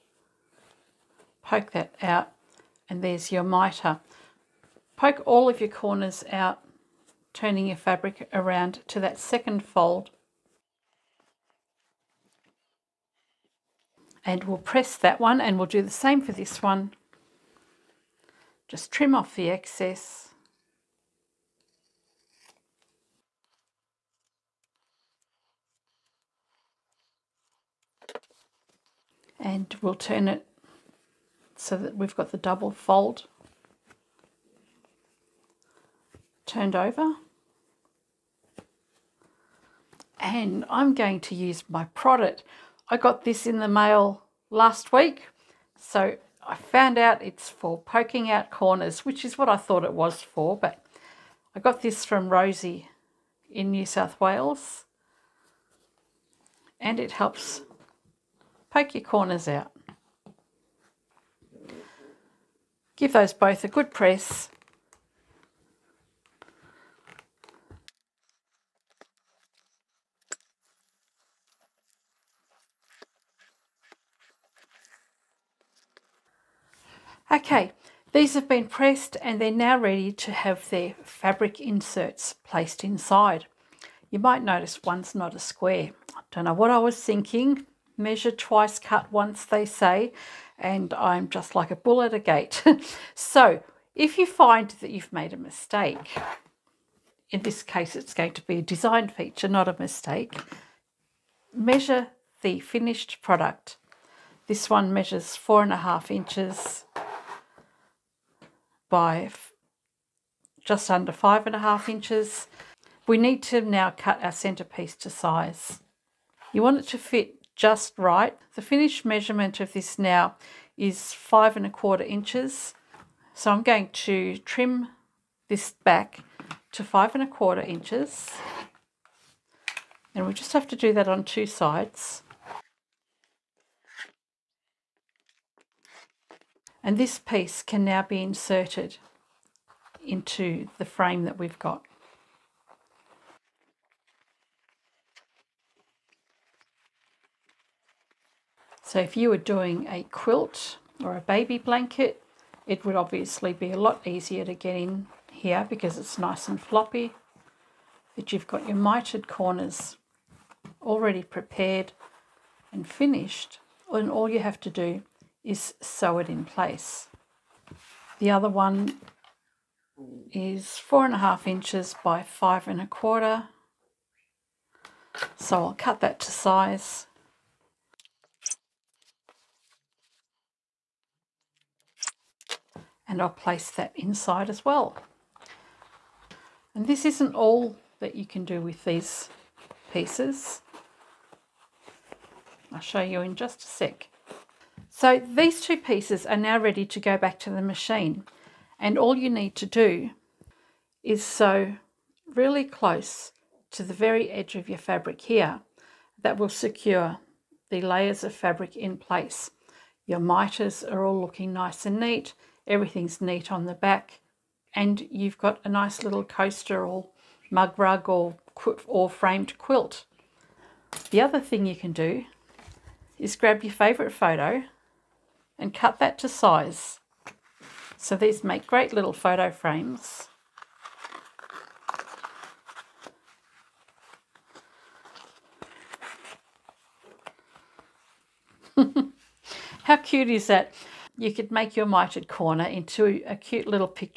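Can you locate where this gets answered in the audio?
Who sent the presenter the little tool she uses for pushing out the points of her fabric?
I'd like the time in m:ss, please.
0:52.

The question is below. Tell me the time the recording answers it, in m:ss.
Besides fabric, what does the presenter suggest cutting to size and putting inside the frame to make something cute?
3:43.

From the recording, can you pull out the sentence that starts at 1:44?
This one measures four and a half inches by just under five and a half inches.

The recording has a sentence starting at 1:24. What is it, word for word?
You might notice one's not a square.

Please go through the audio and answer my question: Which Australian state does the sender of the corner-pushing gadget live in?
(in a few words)
New South Wales.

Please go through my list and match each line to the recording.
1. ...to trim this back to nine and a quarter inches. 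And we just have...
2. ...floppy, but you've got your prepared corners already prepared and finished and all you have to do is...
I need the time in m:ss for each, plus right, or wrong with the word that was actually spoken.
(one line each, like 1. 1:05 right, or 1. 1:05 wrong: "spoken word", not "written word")
1. 2:03 wrong: "five", not "nine"
2. 2:36 wrong: "mitered", not "prepared".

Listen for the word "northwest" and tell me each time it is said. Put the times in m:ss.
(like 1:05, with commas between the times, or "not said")
not said.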